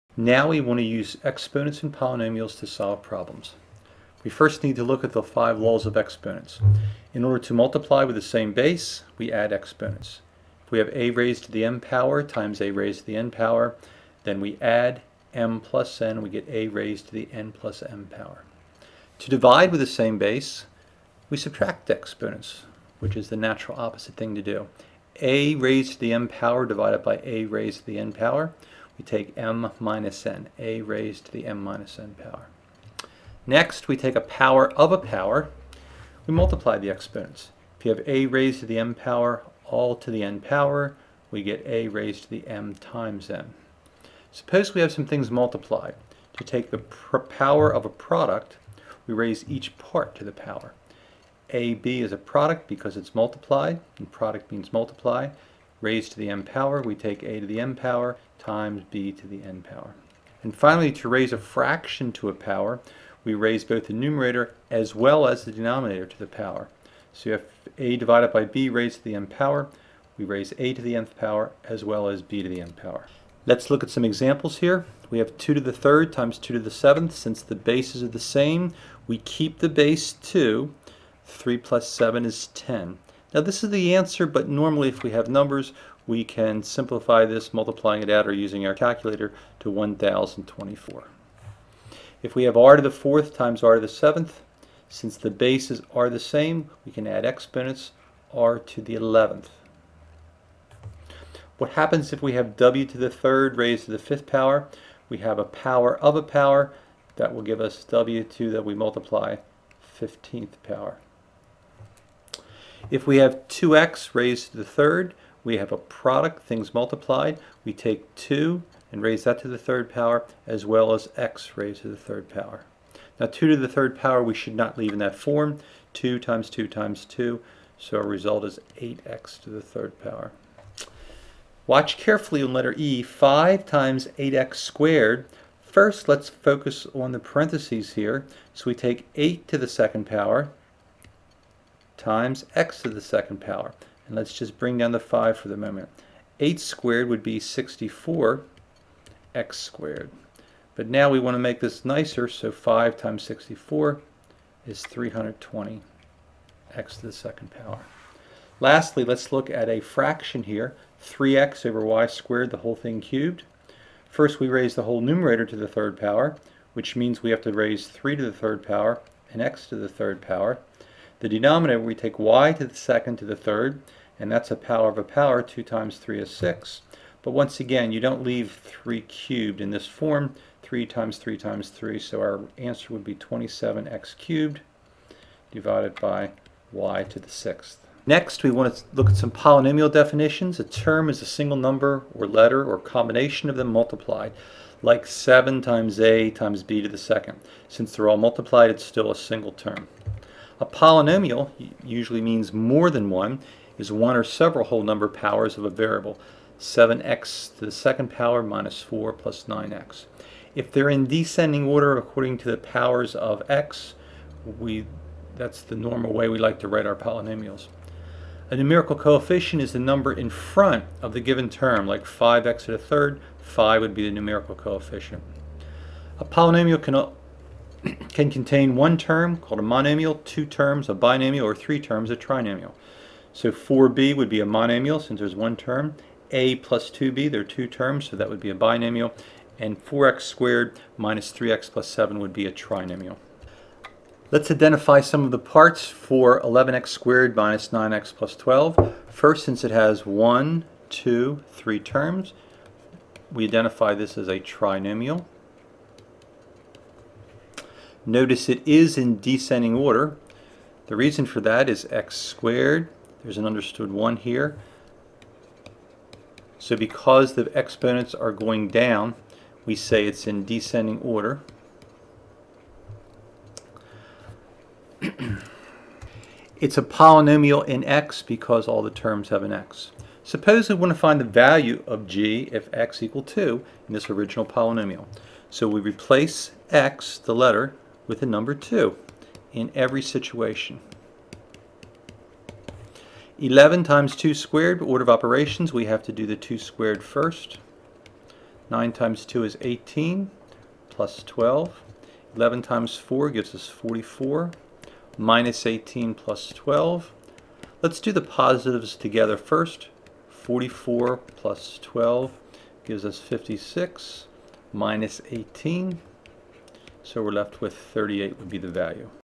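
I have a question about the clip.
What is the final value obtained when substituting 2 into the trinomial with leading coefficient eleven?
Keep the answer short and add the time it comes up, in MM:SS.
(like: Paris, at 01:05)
38, at 05:17.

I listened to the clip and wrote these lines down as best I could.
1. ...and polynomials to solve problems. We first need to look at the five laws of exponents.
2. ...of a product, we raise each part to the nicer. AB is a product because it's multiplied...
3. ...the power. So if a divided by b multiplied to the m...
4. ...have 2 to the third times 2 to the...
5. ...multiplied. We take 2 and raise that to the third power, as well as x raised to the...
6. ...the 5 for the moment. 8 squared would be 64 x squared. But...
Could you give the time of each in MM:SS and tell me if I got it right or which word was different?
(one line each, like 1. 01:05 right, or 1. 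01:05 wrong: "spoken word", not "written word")
1. 00:01 right
2. 00:47 wrong: "power", not "nicer"
3. 01:06 wrong: "raised", not "multiplied"
4. 01:15 right
5. 01:56 right
6. 02:24 right.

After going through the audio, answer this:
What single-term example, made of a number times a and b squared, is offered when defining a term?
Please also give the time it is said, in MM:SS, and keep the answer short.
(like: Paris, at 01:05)
7ab², at 03:15.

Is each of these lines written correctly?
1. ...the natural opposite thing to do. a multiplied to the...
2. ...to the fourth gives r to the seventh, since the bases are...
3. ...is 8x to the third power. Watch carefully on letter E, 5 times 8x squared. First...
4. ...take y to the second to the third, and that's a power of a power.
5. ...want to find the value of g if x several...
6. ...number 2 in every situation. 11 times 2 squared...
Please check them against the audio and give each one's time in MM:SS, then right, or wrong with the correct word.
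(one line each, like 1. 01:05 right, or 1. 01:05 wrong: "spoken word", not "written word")
1. 00:23 wrong: "raised", not "multiplied"
2. 01:32 wrong: "times", not "gives"
3. 02:08 right
4. 02:51 right
5. 04:40 wrong: "equal", not "several"
6. 04:48 right.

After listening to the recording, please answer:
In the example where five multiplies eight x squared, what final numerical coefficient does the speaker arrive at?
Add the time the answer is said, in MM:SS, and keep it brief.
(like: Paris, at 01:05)
320, at 02:34.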